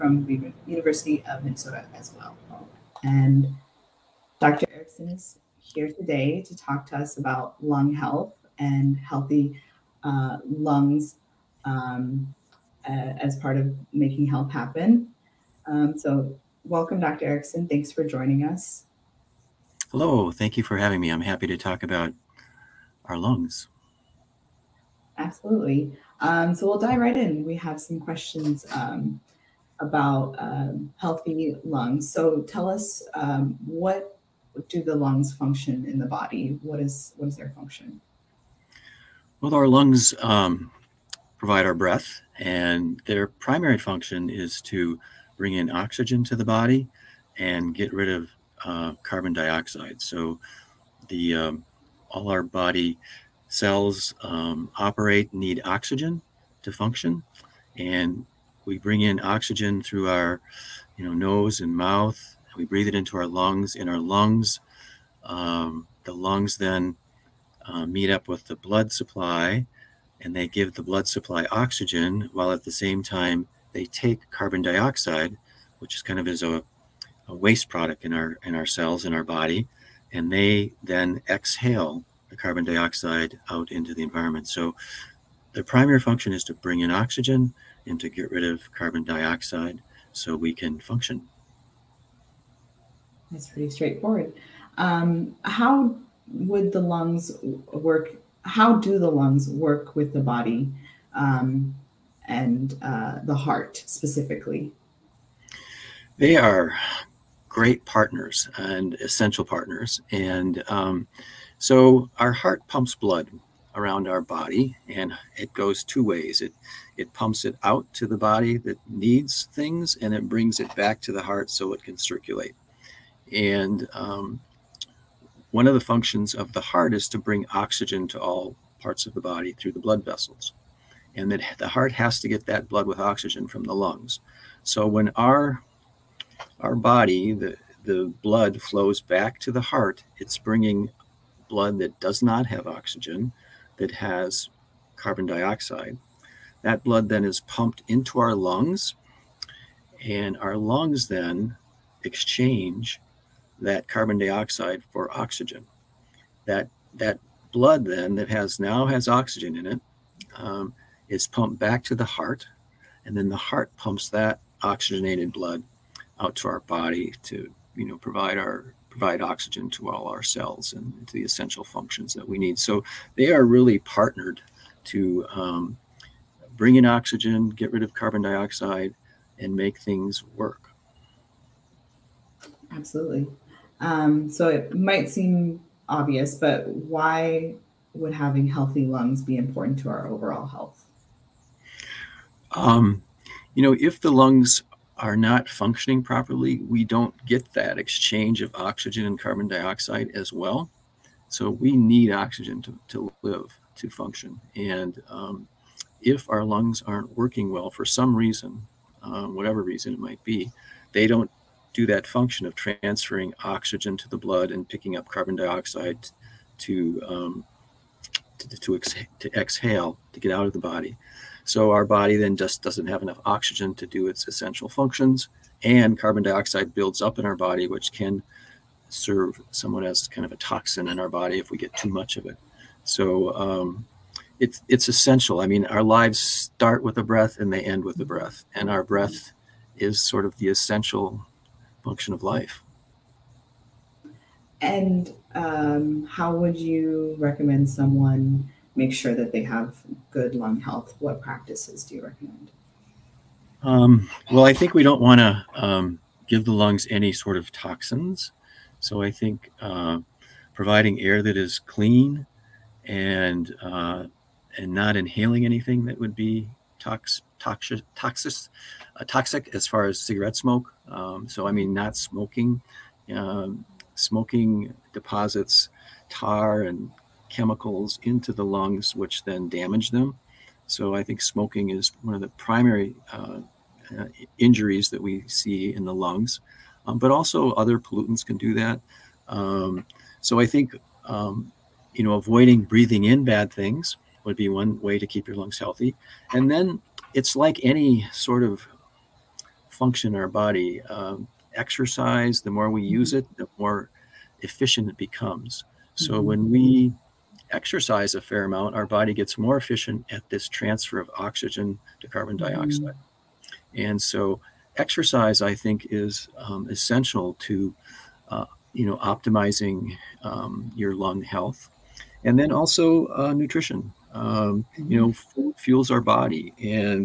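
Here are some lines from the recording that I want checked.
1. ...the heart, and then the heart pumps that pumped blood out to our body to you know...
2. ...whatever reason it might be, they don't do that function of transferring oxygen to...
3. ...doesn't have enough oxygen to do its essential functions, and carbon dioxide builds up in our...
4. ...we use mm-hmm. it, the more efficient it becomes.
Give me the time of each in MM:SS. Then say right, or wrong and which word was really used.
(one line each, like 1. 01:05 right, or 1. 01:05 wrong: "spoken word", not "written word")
1. 02:41 wrong: "oxygenated", not "pumped"
2. 03:29 right
3. 03:42 right
4. 05:02 right.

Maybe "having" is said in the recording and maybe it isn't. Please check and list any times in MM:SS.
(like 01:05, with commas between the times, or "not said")
00:20, 03:08.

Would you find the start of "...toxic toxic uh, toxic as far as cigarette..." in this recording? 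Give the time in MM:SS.
04:27.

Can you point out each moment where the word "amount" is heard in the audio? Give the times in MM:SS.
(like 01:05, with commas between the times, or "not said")
05:08.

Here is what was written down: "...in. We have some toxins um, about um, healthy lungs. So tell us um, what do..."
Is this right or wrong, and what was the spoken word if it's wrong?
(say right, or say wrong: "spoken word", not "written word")
wrong: "questions", not "toxins".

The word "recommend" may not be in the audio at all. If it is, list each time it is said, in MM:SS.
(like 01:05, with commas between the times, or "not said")
04:07, 04:12.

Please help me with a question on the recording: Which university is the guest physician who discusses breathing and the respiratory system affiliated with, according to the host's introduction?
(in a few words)
University of Minnesota.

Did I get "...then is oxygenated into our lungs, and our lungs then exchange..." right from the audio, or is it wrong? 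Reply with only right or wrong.
wrong.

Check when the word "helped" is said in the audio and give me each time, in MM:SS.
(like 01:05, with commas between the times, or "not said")
not said.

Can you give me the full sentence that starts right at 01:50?
And um, so our heart pumps blood around our body and it goes two ways.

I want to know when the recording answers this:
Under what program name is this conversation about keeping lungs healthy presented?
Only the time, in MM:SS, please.
00:13.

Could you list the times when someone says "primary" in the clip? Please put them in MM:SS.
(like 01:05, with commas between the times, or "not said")
00:43, 01:25, 04:42.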